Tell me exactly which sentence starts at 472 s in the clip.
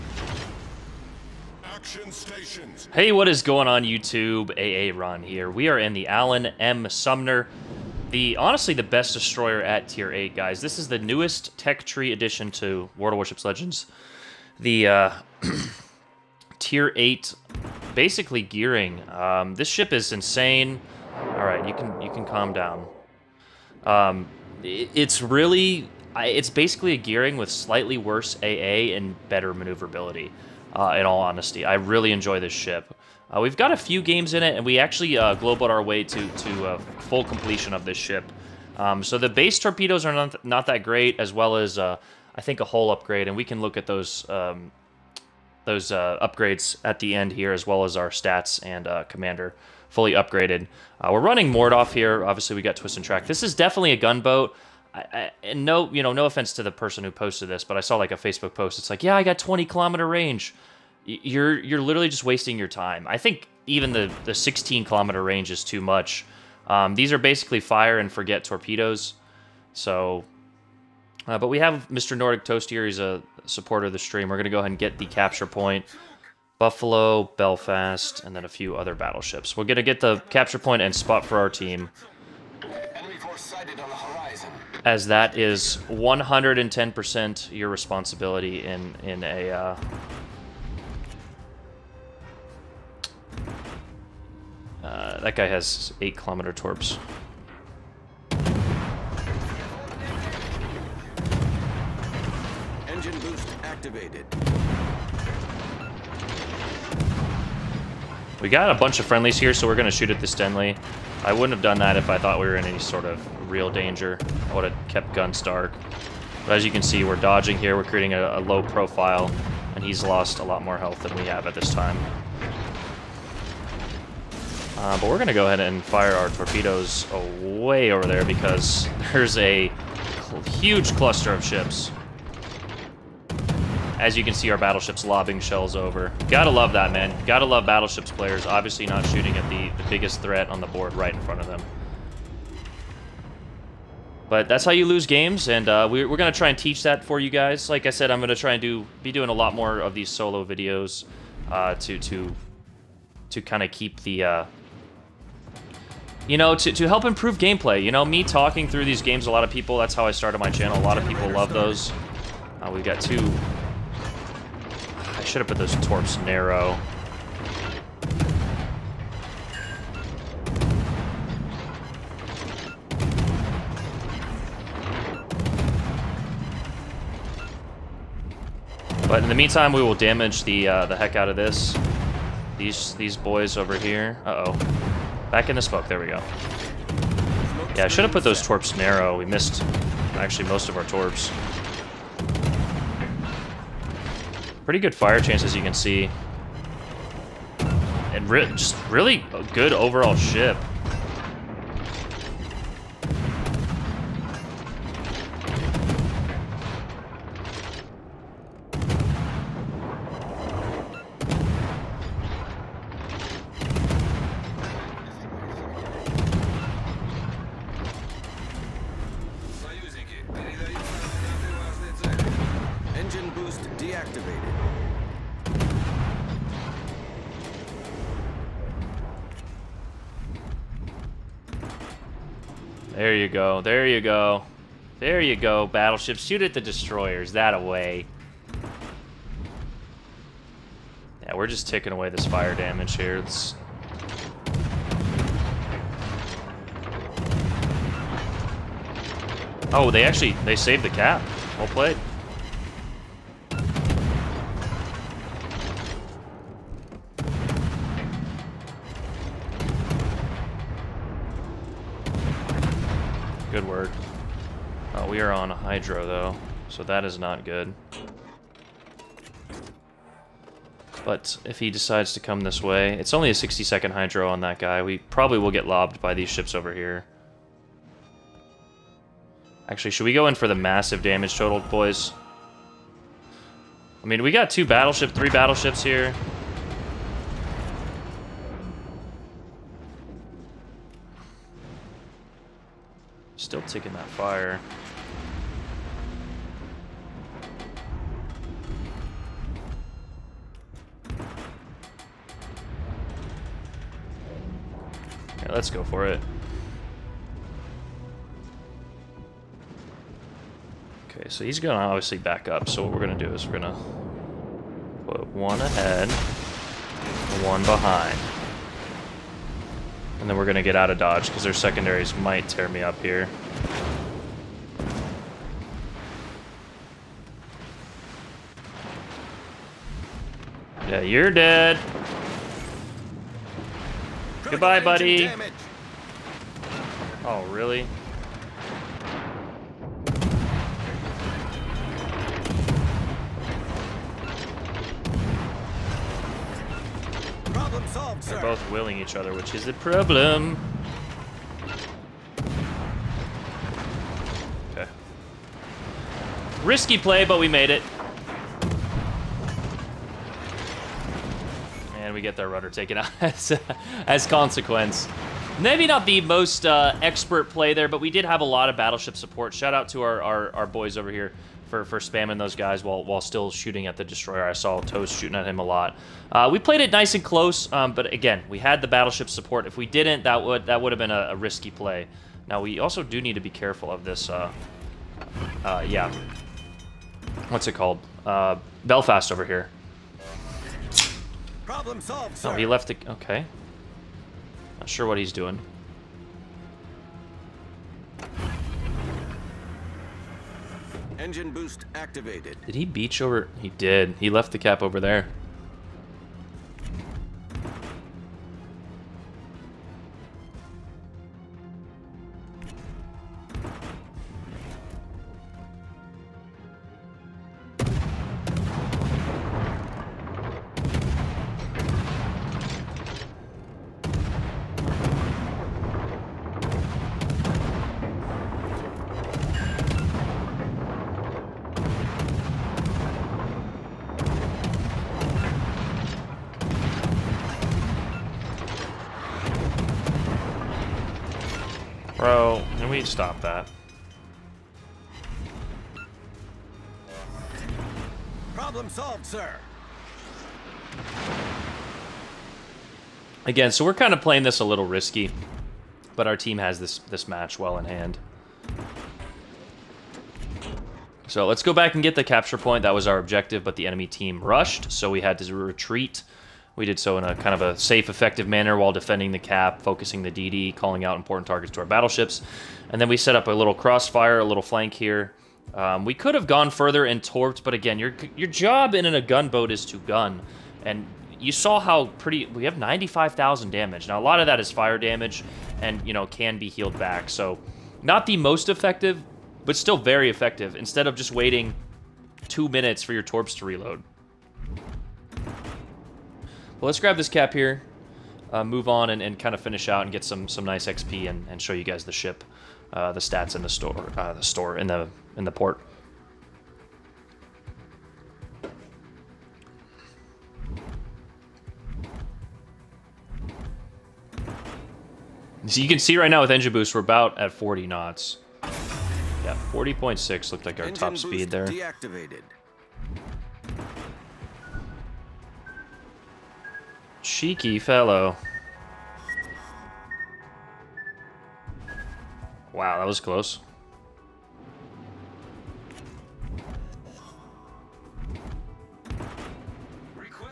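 And then we set up a little crossfire, a little flank here.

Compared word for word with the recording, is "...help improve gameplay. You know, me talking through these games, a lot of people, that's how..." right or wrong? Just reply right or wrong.
right.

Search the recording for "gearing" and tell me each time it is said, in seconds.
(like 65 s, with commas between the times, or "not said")
18 s, 26 s.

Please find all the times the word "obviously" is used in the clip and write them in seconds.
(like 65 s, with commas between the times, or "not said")
52 s, 138 s, 311 s.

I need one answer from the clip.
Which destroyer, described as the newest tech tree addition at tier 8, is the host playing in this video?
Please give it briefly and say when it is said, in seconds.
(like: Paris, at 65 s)
Allen M. Sumner, at 6 s.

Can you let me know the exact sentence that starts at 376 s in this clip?
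Uh, we played it nice and close, um, but again, we had the battleship support.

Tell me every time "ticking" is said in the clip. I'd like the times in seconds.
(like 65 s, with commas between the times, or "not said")
293 s.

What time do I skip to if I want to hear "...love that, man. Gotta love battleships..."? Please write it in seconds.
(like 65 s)
136 s.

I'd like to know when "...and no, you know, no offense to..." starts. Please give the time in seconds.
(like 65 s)
55 s.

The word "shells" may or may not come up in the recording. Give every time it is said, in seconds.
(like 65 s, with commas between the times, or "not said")
135 s.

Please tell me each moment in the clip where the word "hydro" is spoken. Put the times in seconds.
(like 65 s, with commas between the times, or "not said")
265 s, 273 s.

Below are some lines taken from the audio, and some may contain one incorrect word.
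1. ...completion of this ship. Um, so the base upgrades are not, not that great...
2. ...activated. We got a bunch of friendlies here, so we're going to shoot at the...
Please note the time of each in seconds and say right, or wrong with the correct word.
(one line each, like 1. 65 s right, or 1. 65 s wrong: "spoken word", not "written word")
1. 37 s wrong: "torpedoes", not "upgrades"
2. 103 s right.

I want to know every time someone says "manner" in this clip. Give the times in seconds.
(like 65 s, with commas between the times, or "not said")
468 s.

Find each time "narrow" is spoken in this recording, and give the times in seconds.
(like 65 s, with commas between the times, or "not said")
166 s, 188 s.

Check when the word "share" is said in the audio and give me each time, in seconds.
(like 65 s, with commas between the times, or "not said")
not said.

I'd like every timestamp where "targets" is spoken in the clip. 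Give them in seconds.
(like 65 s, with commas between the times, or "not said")
471 s.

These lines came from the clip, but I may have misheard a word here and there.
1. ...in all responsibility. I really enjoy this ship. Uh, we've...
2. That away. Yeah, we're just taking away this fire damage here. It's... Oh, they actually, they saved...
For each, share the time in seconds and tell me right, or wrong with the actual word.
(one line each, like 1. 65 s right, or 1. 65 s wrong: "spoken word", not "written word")
1. 30 s wrong: "honesty", not "responsibility"
2. 237 s right.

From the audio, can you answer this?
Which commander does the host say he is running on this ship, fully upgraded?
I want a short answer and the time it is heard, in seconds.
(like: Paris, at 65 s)
Mordoff, at 51 s.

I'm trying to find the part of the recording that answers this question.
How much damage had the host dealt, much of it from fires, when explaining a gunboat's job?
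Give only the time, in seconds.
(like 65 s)
482 s.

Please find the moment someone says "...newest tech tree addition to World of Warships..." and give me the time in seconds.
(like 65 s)
10 s.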